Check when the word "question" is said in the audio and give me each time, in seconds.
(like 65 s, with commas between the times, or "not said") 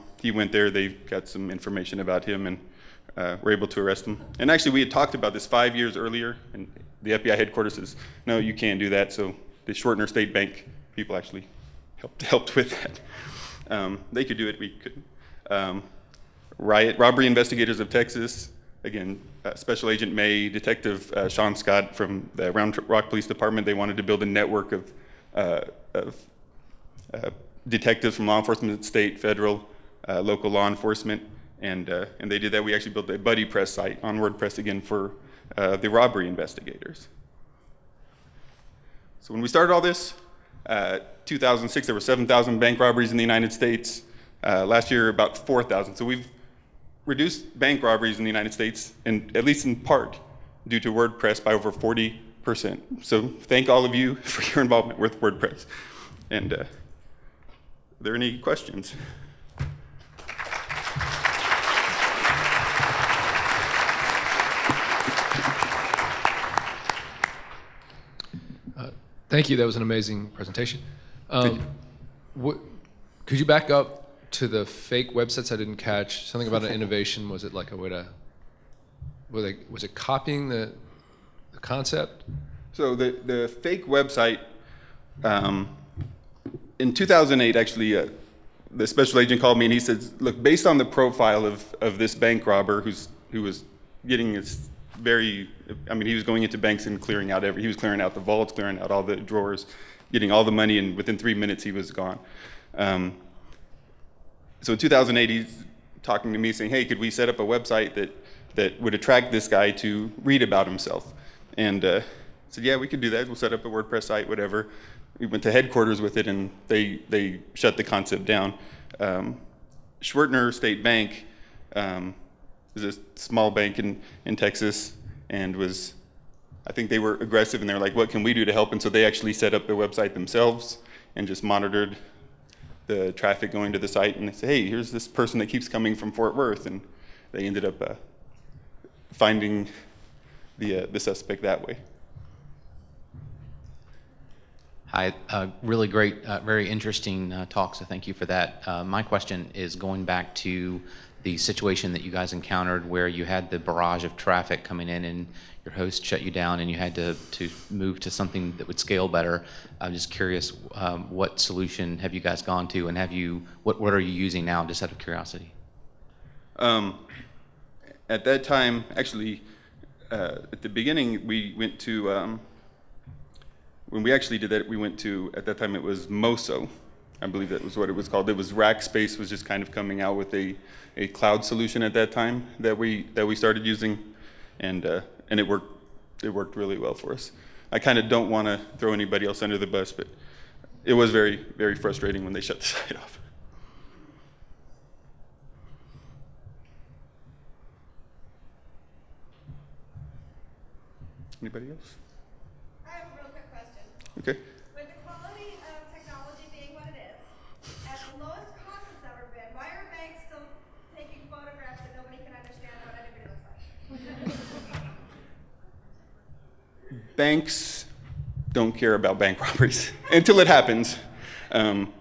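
58 s, 149 s, 203 s.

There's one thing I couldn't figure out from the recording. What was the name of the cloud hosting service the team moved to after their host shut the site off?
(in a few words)
Mosso.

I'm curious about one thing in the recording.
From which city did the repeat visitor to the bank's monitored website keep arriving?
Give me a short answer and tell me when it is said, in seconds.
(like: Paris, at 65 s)
Fort Worth, at 136 s.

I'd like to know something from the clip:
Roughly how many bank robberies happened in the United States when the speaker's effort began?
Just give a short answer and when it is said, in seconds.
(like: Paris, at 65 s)
7,000, at 41 s.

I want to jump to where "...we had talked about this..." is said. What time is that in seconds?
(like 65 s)
4 s.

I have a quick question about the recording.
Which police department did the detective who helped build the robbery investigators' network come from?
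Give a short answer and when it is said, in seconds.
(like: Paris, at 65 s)
Round Rock Police Department, at 22 s.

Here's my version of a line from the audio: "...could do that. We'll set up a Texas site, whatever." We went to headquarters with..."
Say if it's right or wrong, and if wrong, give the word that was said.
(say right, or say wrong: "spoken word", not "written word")
wrong: "WordPress", not "Texas".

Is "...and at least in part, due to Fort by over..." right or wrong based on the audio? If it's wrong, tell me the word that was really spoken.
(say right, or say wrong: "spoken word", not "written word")
wrong: "WordPress", not "Fort".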